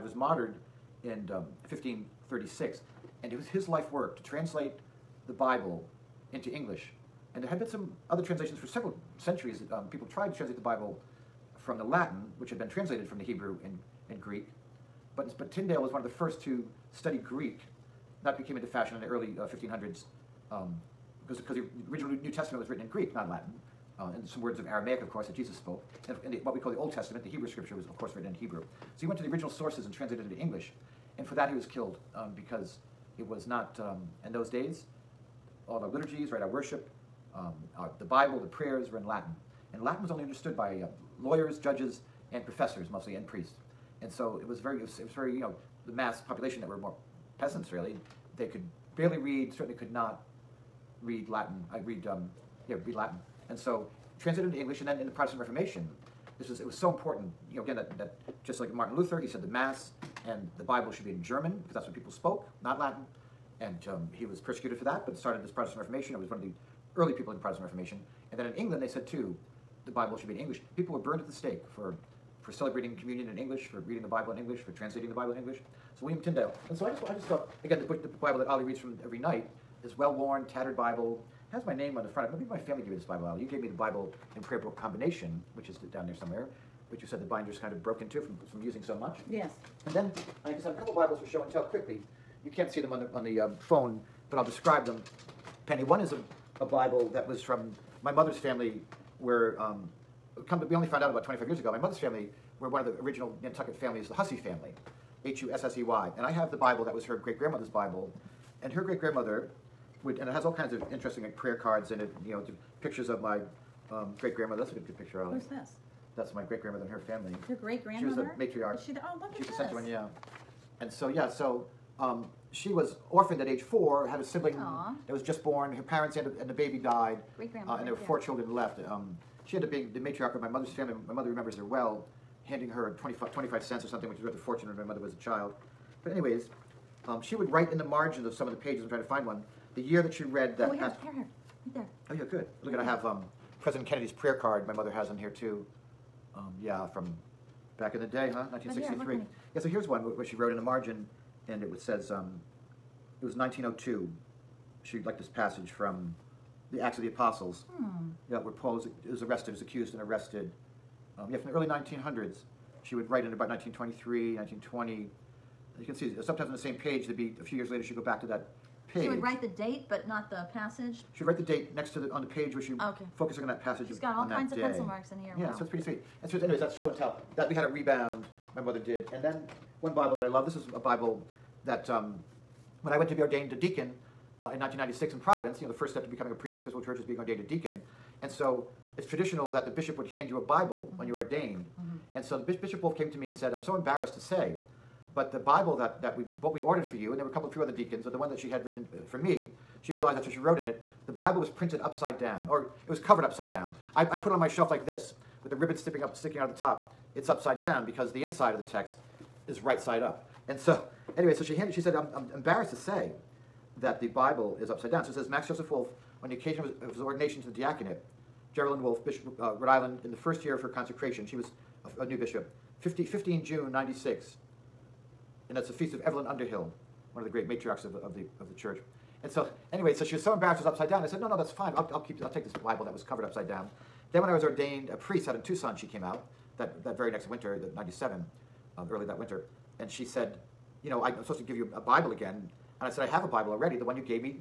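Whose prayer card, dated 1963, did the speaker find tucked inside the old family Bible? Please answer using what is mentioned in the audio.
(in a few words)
President Kennedy.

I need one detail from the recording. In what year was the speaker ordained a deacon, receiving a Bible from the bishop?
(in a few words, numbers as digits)
1996.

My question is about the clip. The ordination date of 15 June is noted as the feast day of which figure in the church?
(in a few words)
Evelyn Underhill.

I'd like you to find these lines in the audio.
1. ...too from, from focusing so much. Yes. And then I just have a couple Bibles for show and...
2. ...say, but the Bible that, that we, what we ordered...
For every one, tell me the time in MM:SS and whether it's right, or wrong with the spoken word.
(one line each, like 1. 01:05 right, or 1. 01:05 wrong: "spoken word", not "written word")
1. 01:28 wrong: "using", not "focusing"
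2. 03:14 right.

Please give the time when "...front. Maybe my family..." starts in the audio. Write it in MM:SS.
01:22.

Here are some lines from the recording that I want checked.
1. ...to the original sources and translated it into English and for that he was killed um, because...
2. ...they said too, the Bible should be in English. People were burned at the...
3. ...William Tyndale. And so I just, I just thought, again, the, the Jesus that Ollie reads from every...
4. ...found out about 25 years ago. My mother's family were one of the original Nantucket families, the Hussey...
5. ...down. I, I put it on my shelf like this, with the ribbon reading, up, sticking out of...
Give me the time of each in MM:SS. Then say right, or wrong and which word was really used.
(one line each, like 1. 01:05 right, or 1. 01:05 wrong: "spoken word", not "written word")
1. 00:29 right
2. 01:08 right
3. 01:16 wrong: "Bible", not "Jesus"
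4. 01:40 right
5. 03:23 wrong: "sticking", not "reading".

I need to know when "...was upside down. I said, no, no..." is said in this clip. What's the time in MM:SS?
03:50.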